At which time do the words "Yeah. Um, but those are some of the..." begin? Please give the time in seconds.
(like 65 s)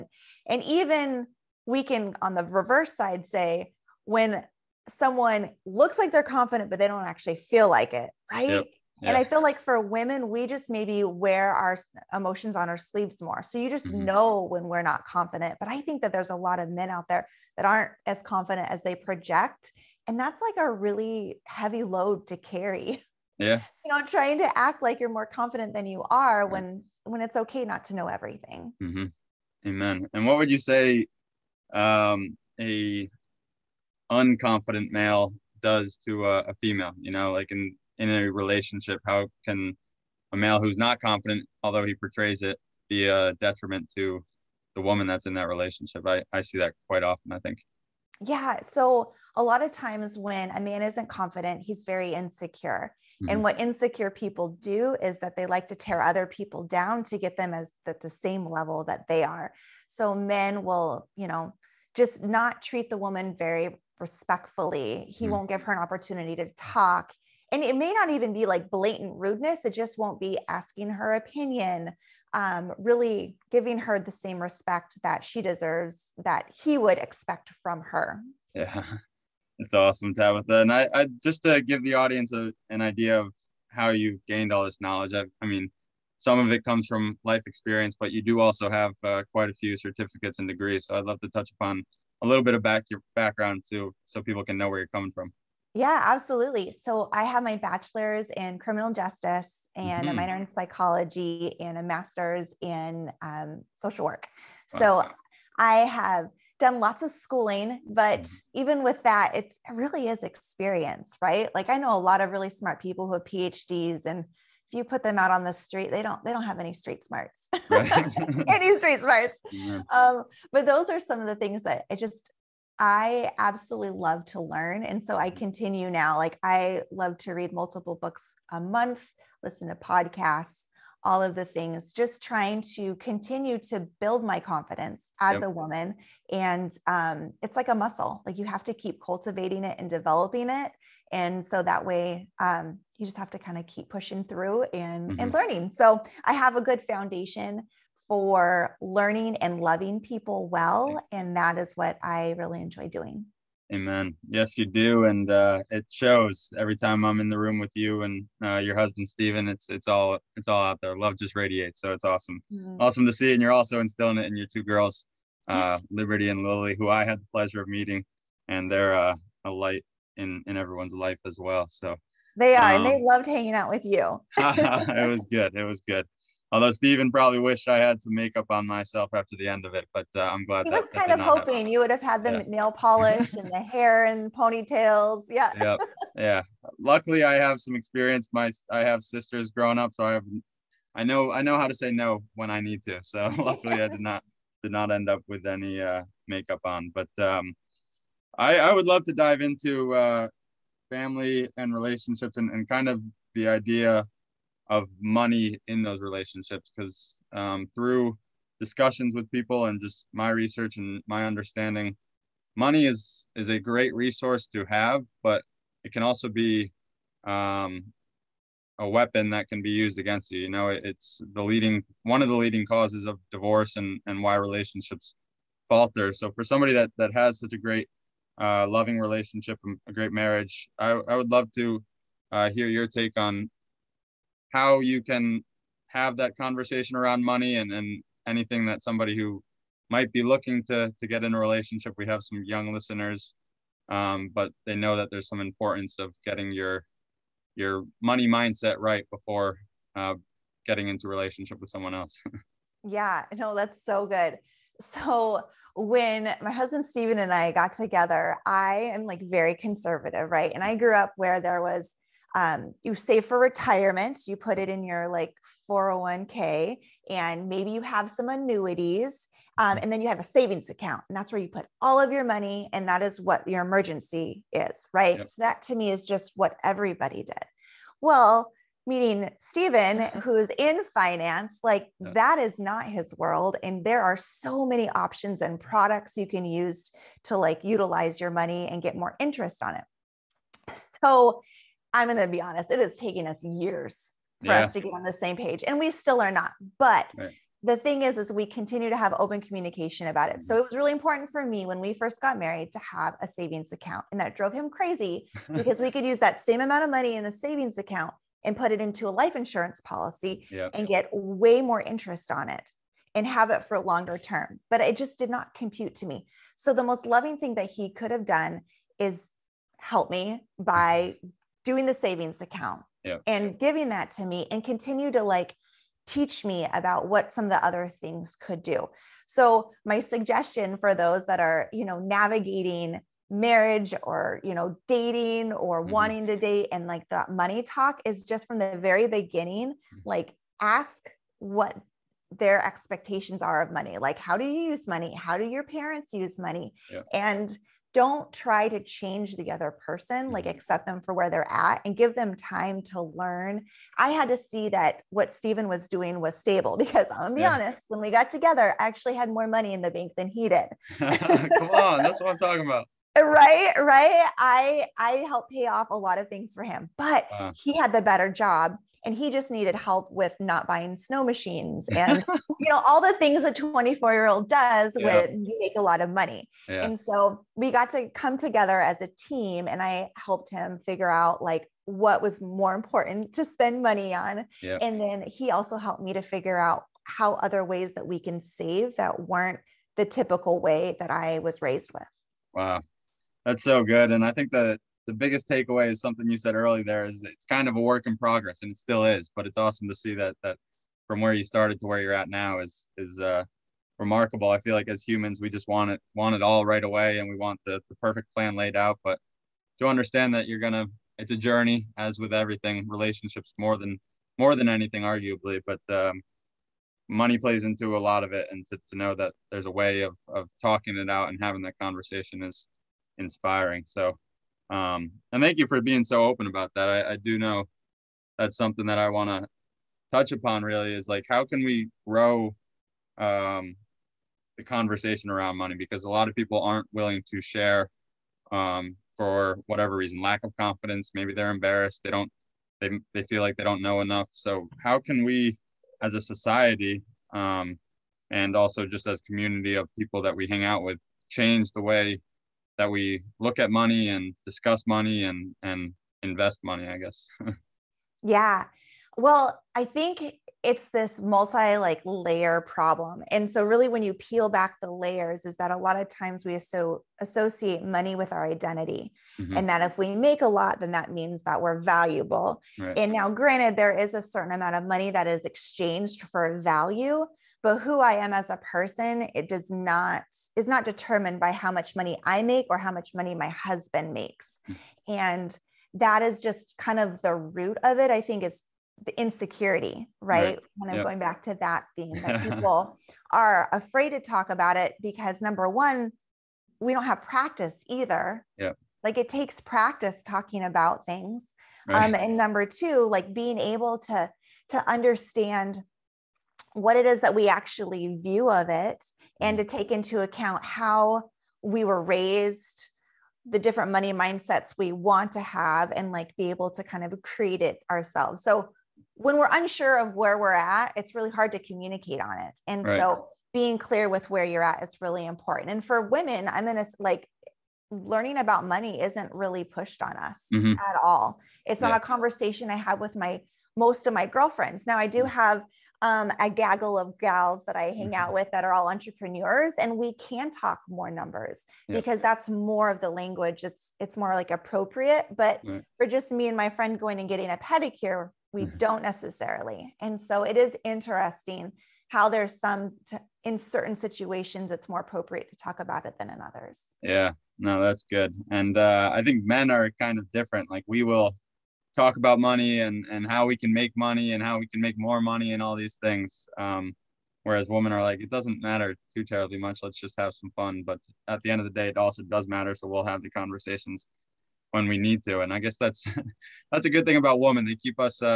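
119 s.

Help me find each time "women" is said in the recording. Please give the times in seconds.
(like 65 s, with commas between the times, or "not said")
9 s, 526 s, 567 s, 577 s.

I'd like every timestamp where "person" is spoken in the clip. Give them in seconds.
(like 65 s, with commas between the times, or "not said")
349 s, 478 s.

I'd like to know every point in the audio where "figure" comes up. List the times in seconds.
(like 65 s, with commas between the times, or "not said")
380 s, 386 s.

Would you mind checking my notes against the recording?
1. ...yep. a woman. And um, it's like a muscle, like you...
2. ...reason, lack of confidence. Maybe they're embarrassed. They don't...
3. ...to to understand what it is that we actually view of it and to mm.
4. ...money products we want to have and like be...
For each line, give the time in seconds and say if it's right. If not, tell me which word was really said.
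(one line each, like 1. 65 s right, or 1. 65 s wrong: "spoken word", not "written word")
1. 135 s right
2. 439 s right
3. 503 s right
4. 513 s wrong: "mindsets", not "products".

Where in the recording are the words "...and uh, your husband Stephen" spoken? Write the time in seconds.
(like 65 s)
158 s.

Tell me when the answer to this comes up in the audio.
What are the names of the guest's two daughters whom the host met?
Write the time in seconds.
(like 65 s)
165 s.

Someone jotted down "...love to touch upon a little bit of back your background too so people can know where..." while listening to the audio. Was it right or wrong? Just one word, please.
right.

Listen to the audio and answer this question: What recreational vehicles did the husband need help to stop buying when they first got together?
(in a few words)
Snow machines.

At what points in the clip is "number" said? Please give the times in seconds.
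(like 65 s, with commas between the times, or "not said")
495 s, 502 s, 541 s.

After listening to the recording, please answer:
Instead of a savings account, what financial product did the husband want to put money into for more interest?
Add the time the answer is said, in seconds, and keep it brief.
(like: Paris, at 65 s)
Life insurance policy, at 309 s.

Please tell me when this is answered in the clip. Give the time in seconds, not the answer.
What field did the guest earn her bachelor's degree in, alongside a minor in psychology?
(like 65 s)
98 s.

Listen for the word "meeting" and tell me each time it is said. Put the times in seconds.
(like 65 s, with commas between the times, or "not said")
167 s, 278 s.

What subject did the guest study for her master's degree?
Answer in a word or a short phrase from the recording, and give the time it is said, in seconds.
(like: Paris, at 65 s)
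Social work, at 103 s.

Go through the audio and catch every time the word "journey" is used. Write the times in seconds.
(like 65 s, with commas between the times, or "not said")
411 s.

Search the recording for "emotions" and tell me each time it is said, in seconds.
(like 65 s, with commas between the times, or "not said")
12 s.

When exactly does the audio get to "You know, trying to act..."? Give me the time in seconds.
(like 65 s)
23 s.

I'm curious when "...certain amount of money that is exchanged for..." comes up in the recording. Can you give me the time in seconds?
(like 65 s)
474 s.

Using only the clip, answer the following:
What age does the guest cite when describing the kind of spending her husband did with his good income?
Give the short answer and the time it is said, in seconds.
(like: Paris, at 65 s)
24, at 373 s.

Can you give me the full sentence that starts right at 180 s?
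He that, was kind of hoping you would have had the yeah.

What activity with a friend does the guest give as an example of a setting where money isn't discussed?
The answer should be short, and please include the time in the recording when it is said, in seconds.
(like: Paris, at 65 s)
Getting a pedicure, at 547 s.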